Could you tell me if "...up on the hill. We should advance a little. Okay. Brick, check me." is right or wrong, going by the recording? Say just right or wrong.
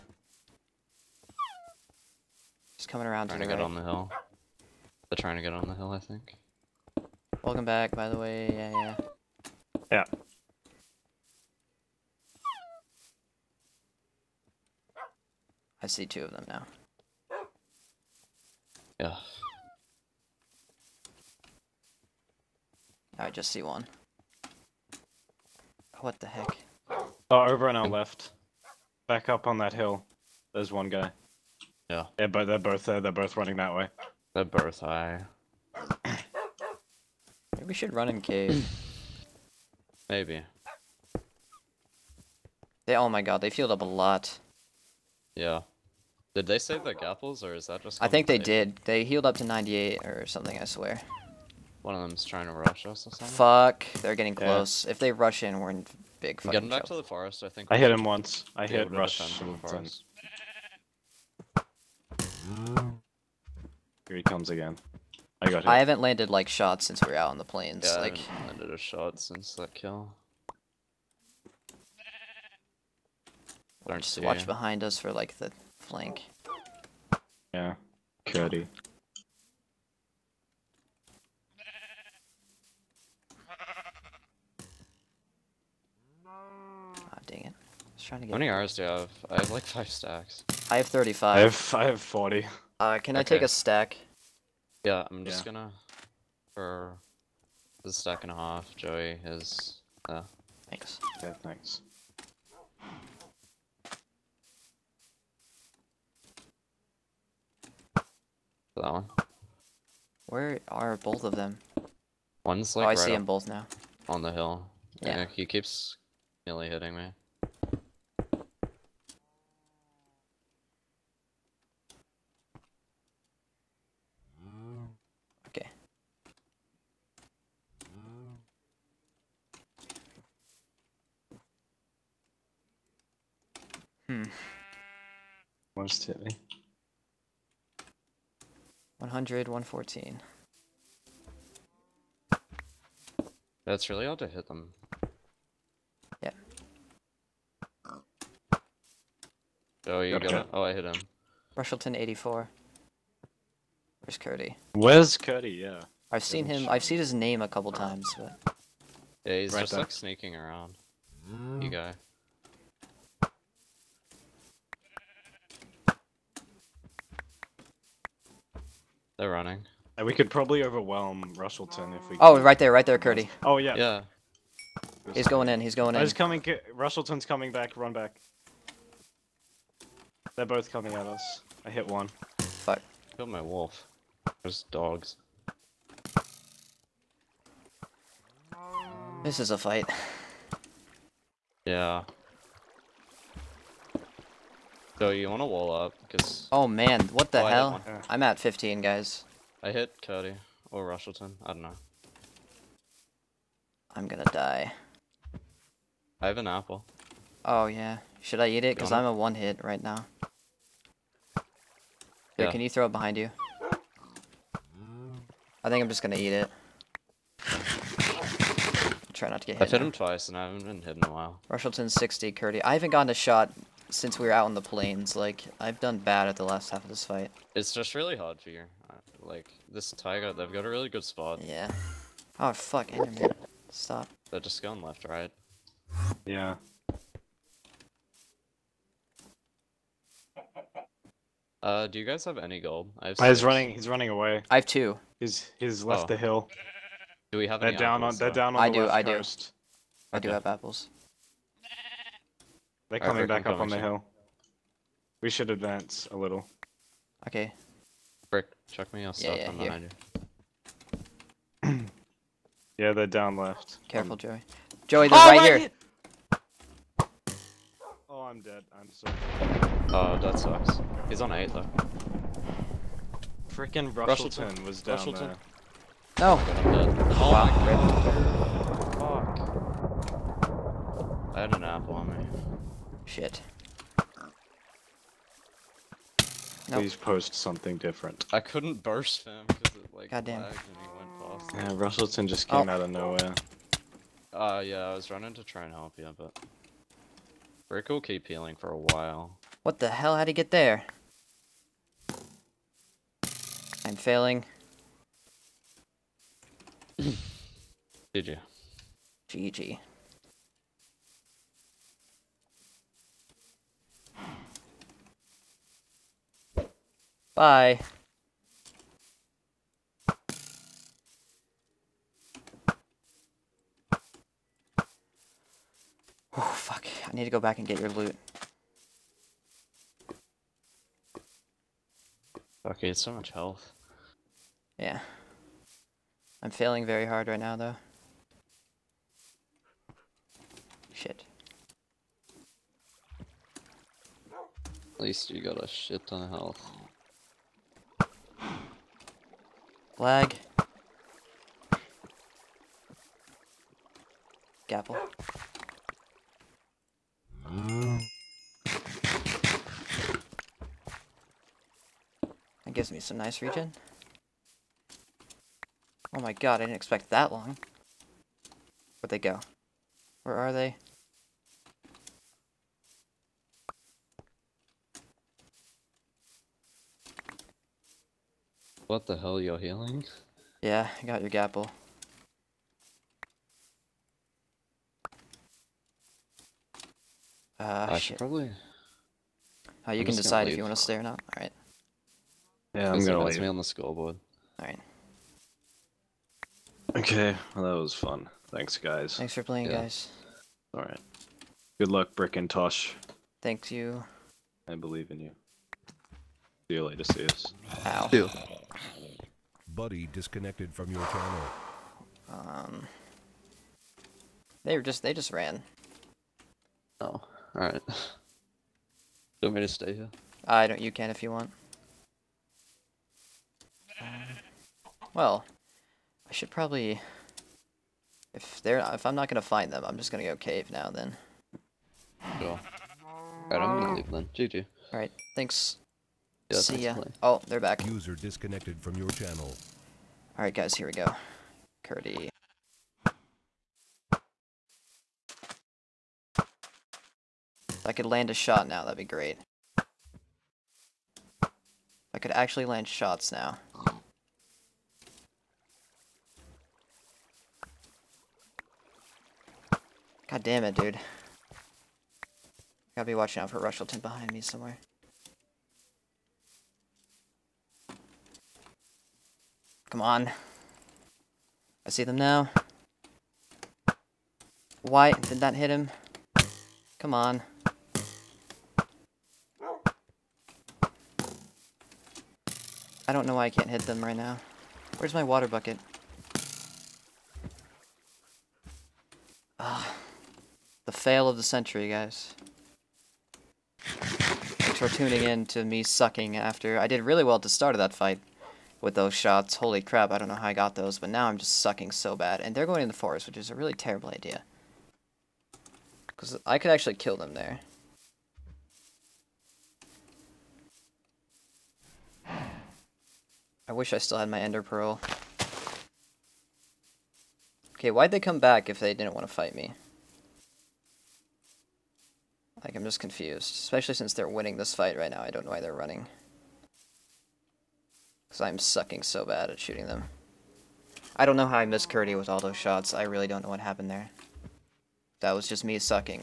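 right.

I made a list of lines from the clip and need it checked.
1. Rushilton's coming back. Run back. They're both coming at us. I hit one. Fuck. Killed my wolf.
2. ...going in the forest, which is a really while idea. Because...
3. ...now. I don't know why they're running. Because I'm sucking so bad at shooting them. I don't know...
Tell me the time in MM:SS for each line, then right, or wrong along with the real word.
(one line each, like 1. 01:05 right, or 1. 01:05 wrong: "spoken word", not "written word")
1. 02:56 right
2. 08:22 wrong: "terrible", not "while"
3. 08:45 right.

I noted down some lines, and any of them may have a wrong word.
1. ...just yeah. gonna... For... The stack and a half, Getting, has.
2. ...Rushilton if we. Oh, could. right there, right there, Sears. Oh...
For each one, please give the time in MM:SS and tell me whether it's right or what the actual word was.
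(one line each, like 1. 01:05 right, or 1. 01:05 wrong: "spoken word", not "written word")
1. 01:35 wrong: "Joey", not "Getting"
2. 02:51 wrong: "Kurdie", not "Sears".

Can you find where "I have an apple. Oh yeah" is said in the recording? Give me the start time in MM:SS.
03:26.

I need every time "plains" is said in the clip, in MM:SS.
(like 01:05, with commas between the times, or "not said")
01:07, 03:44.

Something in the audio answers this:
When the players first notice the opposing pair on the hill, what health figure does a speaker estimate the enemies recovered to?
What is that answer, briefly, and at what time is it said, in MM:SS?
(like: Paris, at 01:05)
98, at 00:48.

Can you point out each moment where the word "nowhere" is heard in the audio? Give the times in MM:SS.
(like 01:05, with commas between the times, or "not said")
04:52.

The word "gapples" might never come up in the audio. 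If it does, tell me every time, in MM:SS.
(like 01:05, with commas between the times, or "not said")
00:46, 05:54, 06:21.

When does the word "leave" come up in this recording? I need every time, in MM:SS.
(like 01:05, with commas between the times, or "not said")
06:33, 07:13.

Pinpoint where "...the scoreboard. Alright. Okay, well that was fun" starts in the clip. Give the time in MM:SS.
06:33.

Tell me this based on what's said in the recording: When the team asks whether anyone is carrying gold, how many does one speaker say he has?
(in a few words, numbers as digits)
2.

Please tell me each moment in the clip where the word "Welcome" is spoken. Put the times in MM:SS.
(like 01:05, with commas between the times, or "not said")
00:07.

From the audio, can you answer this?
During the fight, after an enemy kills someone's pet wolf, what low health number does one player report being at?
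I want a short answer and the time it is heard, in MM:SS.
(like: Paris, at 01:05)
15, at 03:18.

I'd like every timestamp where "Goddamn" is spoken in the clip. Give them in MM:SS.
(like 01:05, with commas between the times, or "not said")
04:50.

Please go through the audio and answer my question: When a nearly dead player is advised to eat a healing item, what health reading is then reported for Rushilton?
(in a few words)
60.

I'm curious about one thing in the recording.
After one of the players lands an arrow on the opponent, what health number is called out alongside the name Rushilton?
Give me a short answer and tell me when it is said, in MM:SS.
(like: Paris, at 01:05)
84, at 02:31.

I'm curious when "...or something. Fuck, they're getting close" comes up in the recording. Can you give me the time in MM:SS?
00:53.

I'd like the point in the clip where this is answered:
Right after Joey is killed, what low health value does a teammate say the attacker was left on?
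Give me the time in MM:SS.
04:31.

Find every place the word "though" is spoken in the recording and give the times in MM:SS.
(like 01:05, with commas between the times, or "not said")
04:31, 05:37.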